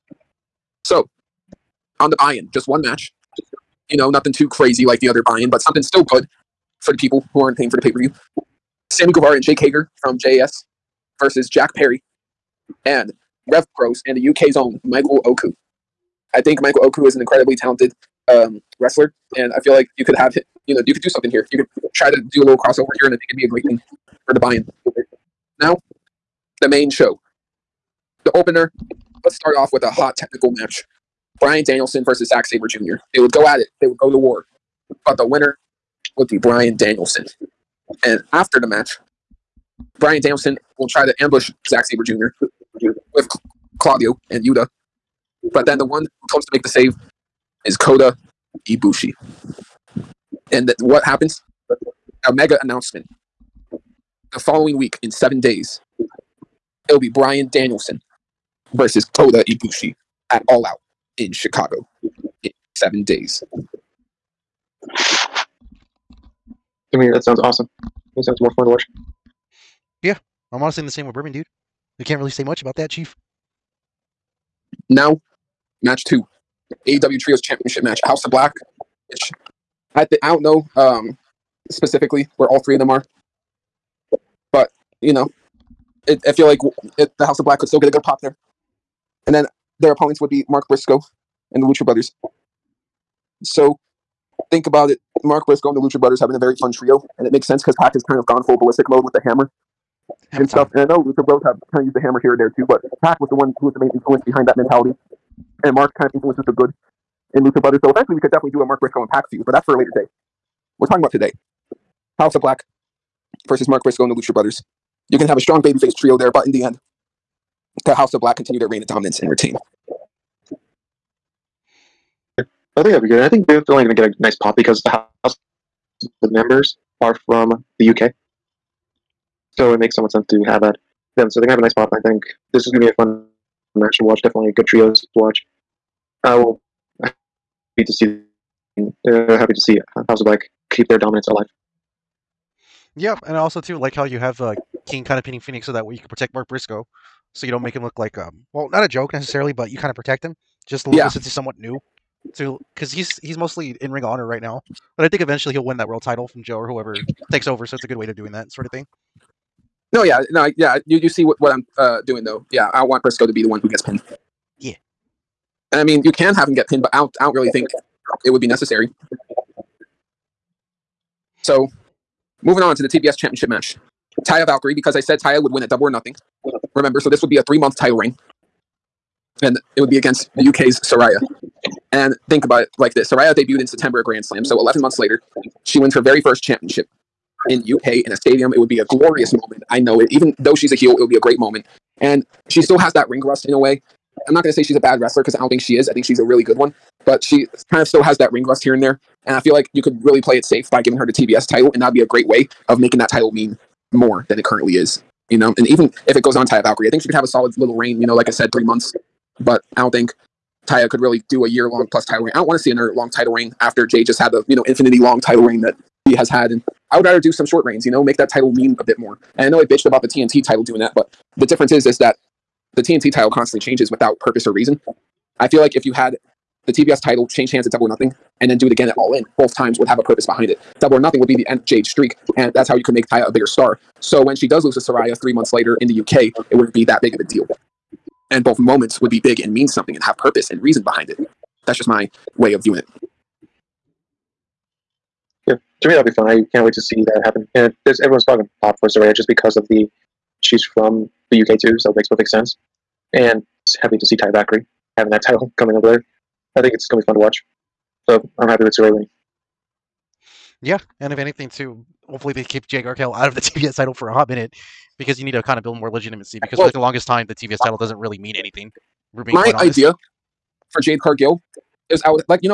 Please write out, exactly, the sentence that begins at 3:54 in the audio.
So when she does lose to Saraya three months later in the UK, it wouldn't be that big of a deal.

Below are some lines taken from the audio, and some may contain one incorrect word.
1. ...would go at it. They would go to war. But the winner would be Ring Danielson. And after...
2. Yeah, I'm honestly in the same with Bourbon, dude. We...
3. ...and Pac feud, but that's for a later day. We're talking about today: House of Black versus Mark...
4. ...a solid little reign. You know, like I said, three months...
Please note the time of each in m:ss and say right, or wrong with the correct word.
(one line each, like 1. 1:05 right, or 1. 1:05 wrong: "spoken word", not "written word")
1. 0:33 wrong: "Bryan", not "Ring"
2. 1:10 right
3. 1:49 right
4. 3:27 right.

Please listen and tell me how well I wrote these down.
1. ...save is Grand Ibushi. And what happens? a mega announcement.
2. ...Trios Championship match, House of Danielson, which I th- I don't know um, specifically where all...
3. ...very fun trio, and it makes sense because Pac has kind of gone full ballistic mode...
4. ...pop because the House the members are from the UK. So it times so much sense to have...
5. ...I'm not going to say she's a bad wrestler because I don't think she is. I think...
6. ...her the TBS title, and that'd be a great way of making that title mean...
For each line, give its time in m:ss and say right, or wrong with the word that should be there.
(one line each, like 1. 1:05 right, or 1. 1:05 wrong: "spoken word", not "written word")
1. 0:46 wrong: "Kota", not "Grand"
2. 1:17 wrong: "Black", not "Danielson"
3. 1:36 right
4. 2:04 wrong: "makes", not "times"
5. 3:14 right
6. 3:20 right.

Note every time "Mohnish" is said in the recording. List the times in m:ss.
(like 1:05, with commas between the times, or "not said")
not said.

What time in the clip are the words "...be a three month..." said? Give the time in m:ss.
2:57.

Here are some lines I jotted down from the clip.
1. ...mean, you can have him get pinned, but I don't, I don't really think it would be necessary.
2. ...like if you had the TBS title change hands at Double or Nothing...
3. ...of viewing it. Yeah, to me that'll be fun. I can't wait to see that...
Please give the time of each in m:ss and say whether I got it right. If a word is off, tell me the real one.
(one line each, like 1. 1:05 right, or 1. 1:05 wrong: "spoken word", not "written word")
1. 2:45 right
2. 3:45 right
3. 4:02 right.